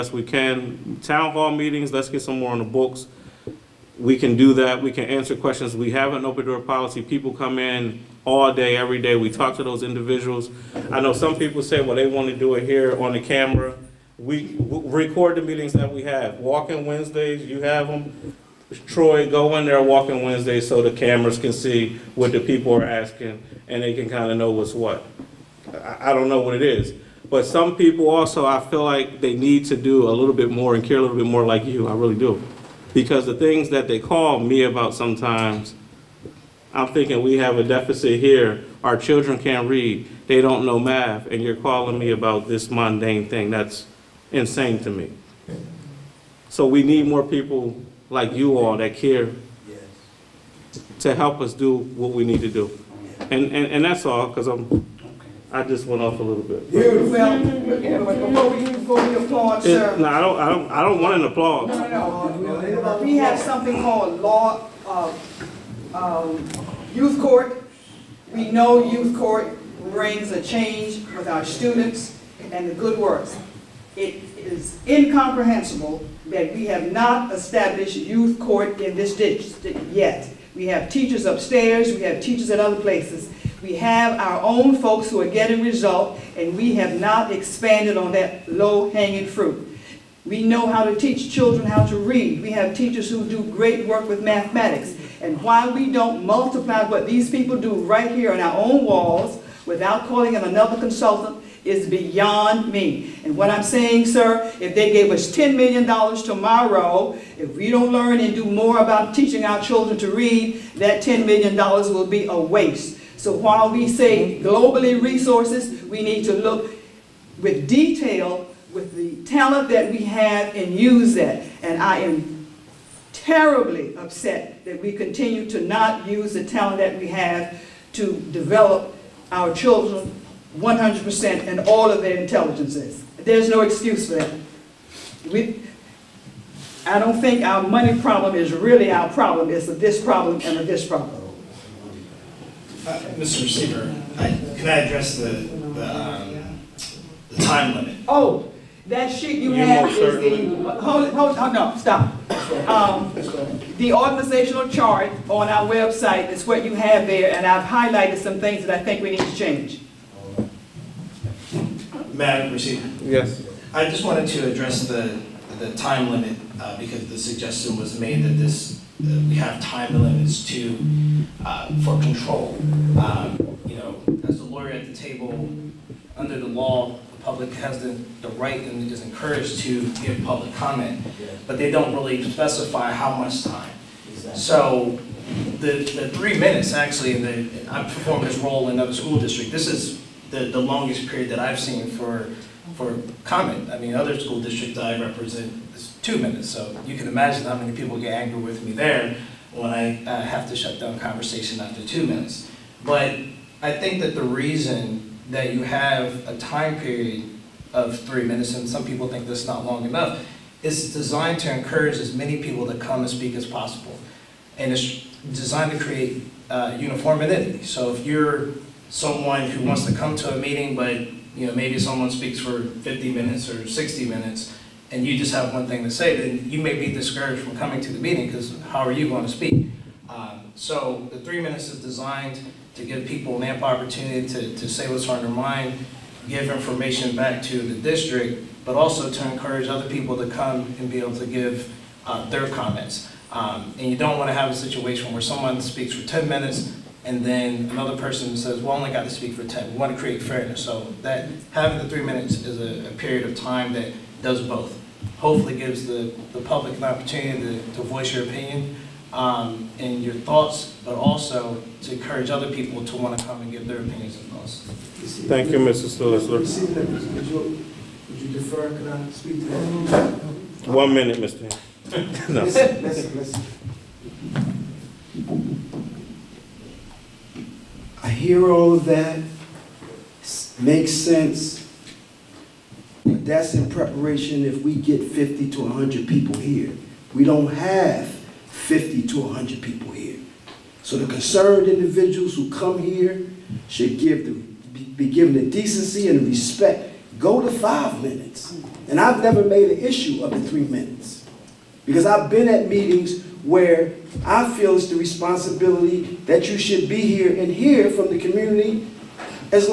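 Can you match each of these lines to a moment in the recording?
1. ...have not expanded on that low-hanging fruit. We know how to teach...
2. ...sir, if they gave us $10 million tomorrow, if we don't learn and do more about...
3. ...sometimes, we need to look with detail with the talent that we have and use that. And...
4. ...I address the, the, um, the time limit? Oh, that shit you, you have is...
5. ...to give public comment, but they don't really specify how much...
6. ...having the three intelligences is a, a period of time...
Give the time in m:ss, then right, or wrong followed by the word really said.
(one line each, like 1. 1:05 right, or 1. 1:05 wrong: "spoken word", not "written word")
1. 1:26 right
2. 1:44 right
3. 1:54 wrong: "resources", not "sometimes"
4. 2:24 right
5. 2:59 right
6. 4:11 wrong: "minutes", not "intelligences".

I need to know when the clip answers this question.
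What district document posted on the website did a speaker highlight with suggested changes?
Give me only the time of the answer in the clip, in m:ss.
2:33.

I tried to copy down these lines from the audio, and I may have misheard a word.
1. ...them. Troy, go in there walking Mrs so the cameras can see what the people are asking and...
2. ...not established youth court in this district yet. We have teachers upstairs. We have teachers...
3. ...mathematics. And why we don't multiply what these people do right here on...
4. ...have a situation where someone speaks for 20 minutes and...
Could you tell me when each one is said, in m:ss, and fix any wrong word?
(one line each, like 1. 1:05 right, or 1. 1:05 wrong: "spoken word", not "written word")
1. 0:17 wrong: "Wednesdays", not "Mrs"
2. 1:16 right
3. 1:34 right
4. 4:04 wrong: "10", not "20".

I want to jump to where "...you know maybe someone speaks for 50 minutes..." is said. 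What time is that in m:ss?
3:41.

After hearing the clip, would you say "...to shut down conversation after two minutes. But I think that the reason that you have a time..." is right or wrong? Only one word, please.
right.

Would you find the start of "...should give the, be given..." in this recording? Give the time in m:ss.
4:53.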